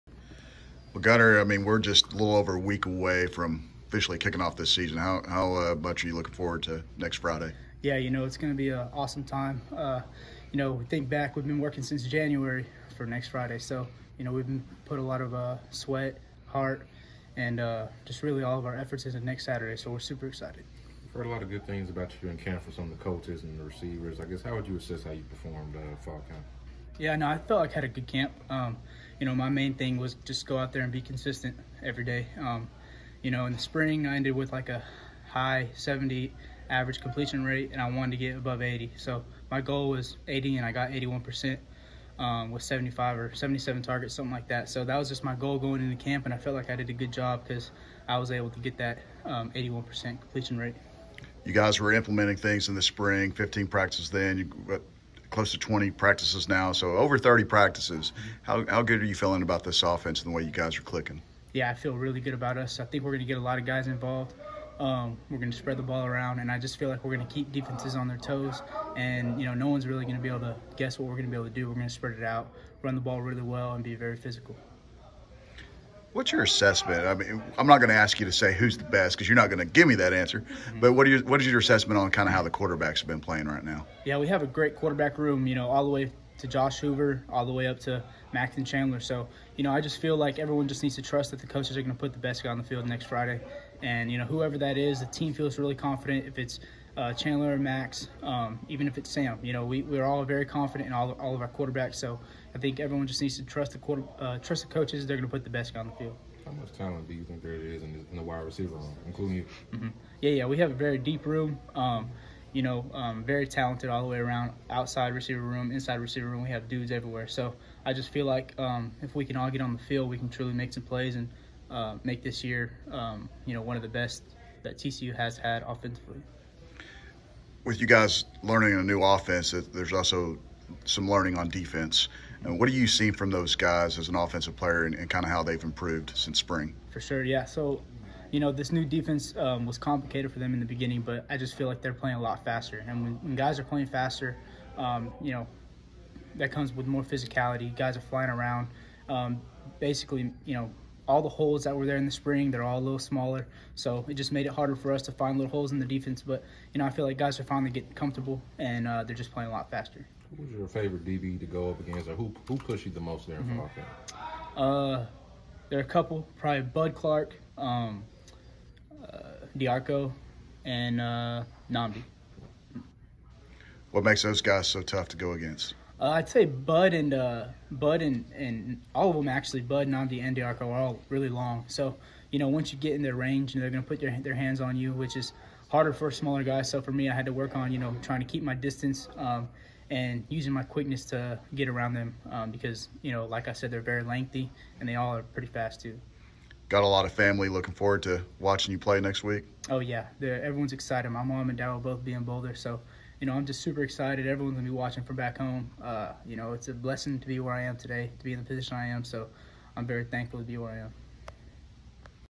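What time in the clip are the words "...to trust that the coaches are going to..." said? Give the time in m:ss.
1:30.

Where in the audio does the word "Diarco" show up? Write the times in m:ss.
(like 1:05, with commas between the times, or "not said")
2:49, 3:00.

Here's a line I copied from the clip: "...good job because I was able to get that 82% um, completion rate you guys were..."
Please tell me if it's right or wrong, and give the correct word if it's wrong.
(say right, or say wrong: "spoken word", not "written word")
wrong: "81", not "82".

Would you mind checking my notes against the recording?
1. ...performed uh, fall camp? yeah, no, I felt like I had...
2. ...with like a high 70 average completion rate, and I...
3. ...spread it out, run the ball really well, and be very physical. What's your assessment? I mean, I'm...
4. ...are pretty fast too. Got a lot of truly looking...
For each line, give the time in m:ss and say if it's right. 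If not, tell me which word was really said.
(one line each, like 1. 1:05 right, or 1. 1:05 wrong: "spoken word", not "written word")
1. 0:25 right
2. 0:34 right
3. 1:11 right
4. 3:15 wrong: "family", not "truly".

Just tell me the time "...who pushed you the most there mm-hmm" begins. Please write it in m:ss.
2:42.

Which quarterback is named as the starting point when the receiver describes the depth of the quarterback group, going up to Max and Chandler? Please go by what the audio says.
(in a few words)
Josh Hoover.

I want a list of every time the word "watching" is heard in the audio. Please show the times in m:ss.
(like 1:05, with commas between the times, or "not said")
3:18, 3:24.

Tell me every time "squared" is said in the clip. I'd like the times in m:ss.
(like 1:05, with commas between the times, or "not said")
not said.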